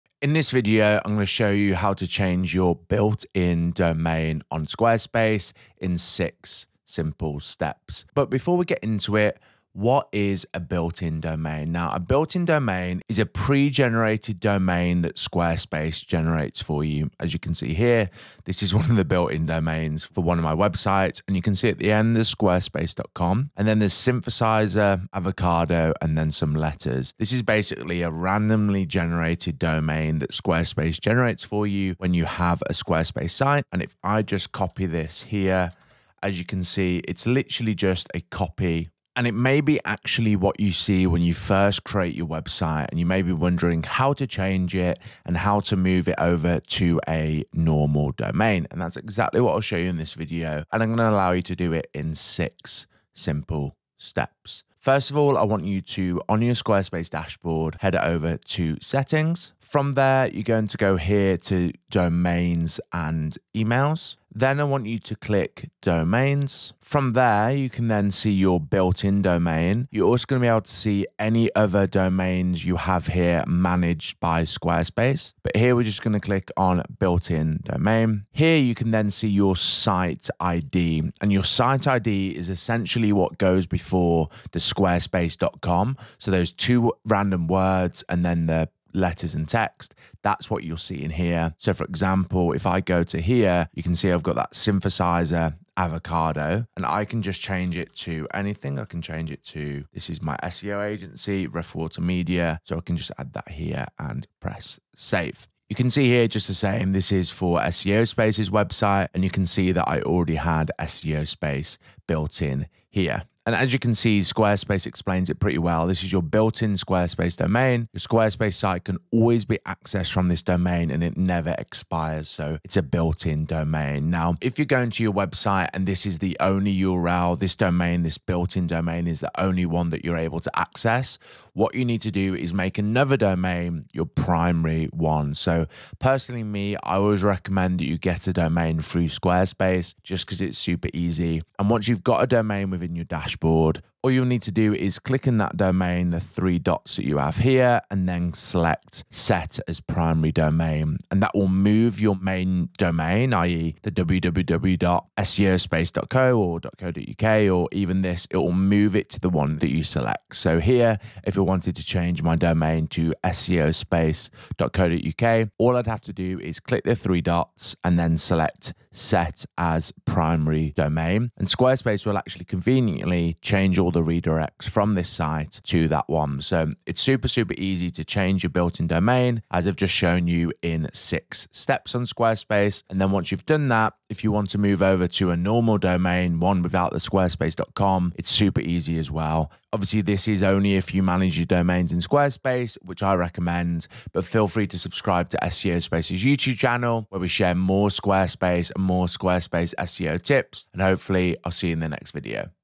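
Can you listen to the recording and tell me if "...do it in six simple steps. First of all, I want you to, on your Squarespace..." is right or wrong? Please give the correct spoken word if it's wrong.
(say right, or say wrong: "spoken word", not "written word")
right.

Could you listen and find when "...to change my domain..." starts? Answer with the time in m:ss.
2:41.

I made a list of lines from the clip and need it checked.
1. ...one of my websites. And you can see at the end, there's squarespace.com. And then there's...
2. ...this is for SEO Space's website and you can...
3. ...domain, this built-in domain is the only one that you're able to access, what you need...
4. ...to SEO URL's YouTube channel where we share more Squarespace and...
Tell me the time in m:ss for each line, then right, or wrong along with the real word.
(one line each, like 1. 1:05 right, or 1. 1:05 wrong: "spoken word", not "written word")
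1. 0:20 right
2. 1:46 right
3. 2:07 right
4. 3:15 wrong: "Space", not "URL".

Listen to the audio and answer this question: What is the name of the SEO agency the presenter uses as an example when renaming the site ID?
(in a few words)
Rough Water Media.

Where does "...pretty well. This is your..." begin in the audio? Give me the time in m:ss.
1:55.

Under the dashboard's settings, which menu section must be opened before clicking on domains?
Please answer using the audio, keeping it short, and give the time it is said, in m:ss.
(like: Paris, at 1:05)
domains and emails, at 1:01.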